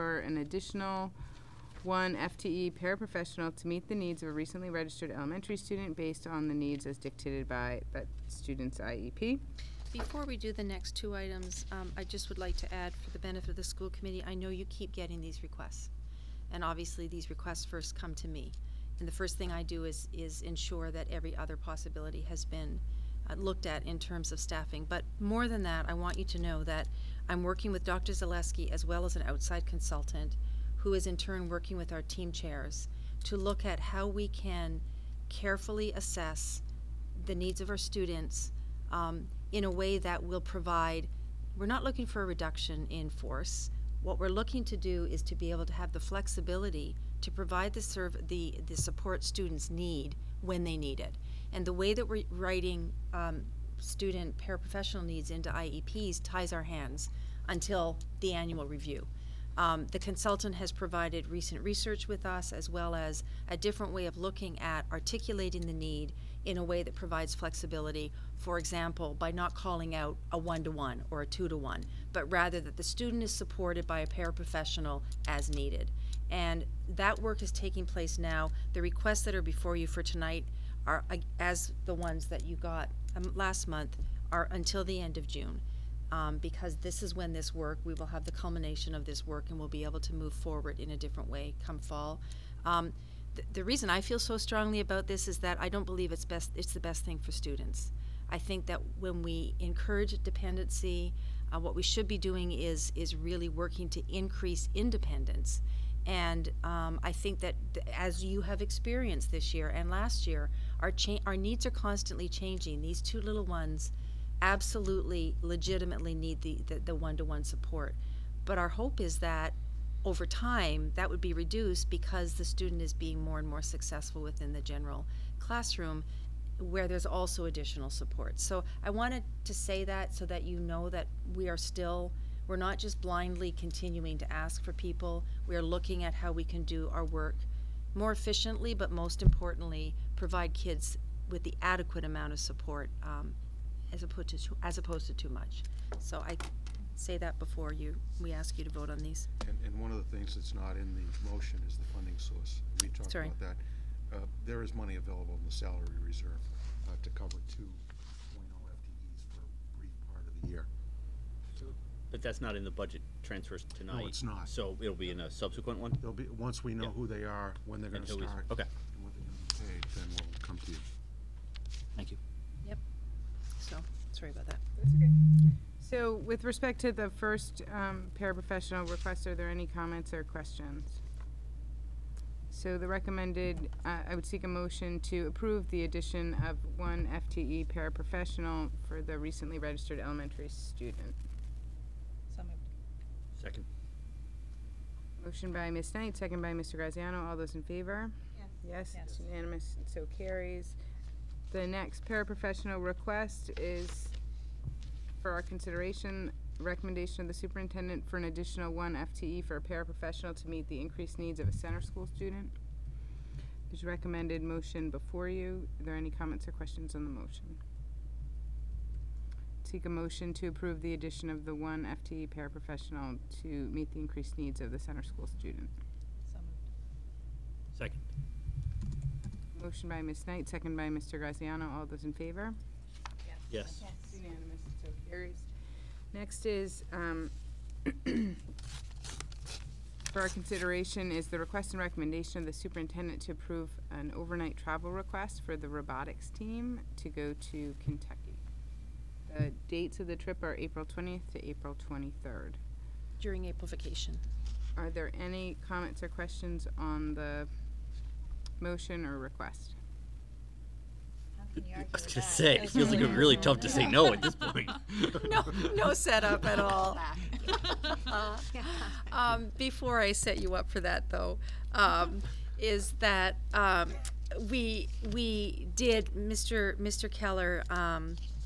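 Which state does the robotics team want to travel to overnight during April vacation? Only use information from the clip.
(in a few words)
Kentucky.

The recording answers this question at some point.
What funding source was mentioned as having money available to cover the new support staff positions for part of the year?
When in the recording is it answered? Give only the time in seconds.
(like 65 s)
155 s.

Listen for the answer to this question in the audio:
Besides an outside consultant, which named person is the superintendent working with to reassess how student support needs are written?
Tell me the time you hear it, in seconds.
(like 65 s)
27 s.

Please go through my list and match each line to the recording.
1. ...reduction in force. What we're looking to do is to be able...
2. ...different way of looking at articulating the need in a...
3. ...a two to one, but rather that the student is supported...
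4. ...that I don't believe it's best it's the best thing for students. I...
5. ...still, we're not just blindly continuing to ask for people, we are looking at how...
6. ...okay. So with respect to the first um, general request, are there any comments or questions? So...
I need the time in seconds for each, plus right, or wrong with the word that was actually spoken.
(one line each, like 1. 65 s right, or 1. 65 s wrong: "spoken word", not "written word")
1. 42 s right
2. 63 s right
3. 71 s right
4. 95 s right
5. 131 s right
6. 174 s wrong: "paraprofessional", not "general".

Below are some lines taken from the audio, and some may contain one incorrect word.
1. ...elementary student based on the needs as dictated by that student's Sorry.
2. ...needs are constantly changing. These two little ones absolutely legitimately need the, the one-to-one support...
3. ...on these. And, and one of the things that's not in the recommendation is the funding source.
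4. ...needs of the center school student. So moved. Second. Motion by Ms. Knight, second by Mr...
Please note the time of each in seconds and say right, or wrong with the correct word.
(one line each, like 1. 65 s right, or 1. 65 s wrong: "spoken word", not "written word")
1. 5 s wrong: "IEP", not "Sorry"
2. 111 s right
3. 148 s wrong: "motion", not "recommendation"
4. 224 s right.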